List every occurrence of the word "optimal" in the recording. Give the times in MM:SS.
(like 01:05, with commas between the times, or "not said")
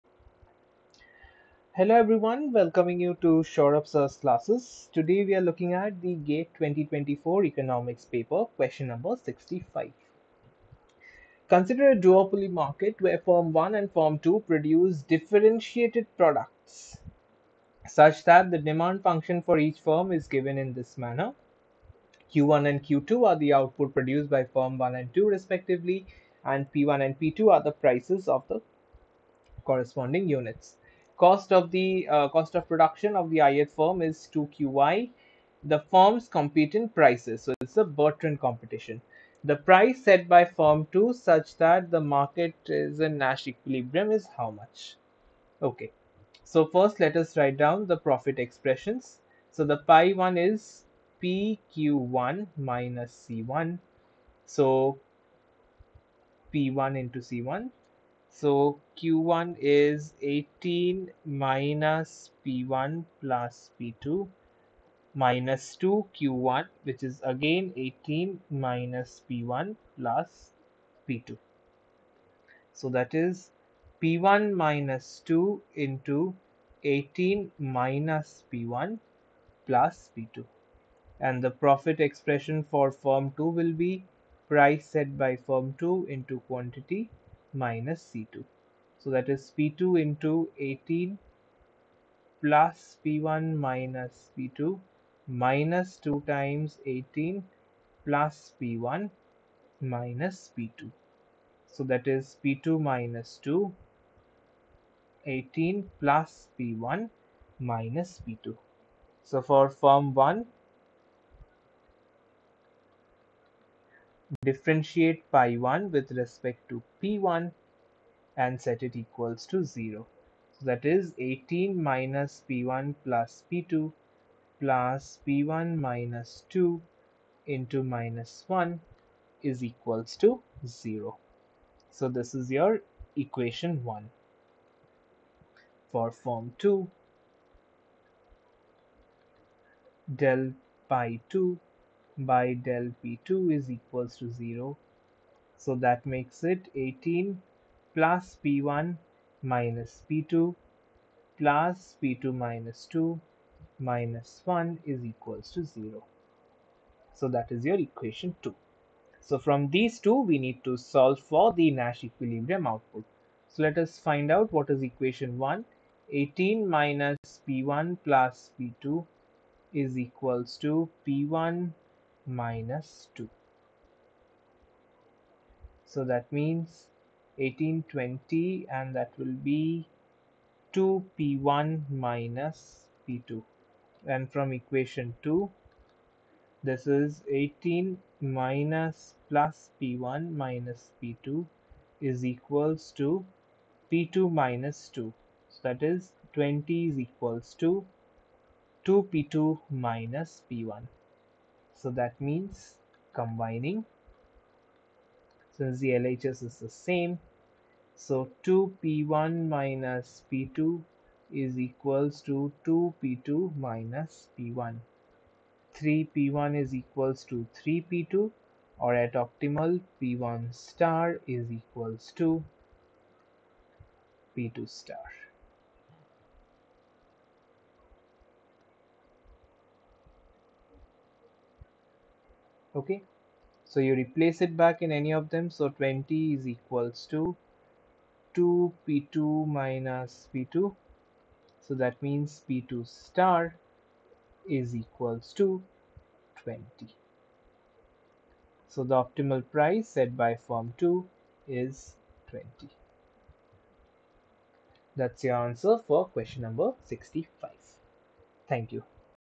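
03:39, 04:08.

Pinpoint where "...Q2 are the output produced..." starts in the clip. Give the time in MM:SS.
00:22.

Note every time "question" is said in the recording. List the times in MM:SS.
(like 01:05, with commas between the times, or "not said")
00:08, 04:16.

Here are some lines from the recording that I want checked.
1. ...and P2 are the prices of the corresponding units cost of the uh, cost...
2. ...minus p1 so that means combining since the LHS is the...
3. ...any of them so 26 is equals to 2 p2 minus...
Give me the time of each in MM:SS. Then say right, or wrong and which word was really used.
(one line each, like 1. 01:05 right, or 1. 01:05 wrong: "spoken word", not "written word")
1. 00:27 right
2. 03:19 right
3. 03:54 wrong: "20", not "26".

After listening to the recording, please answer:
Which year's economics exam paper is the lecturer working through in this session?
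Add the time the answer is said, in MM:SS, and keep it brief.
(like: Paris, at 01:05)
2024, at 00:06.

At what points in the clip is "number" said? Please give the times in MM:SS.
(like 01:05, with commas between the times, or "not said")
00:08, 04:16.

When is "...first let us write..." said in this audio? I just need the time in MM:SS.
00:46.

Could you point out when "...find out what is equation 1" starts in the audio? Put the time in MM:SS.
02:43.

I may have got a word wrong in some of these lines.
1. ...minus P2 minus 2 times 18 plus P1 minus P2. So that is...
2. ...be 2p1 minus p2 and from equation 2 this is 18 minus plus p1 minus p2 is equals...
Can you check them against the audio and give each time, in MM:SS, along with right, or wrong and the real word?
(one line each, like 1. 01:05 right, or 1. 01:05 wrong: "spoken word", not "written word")
1. 01:33 right
2. 02:59 right.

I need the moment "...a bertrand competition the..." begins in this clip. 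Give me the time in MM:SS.
00:37.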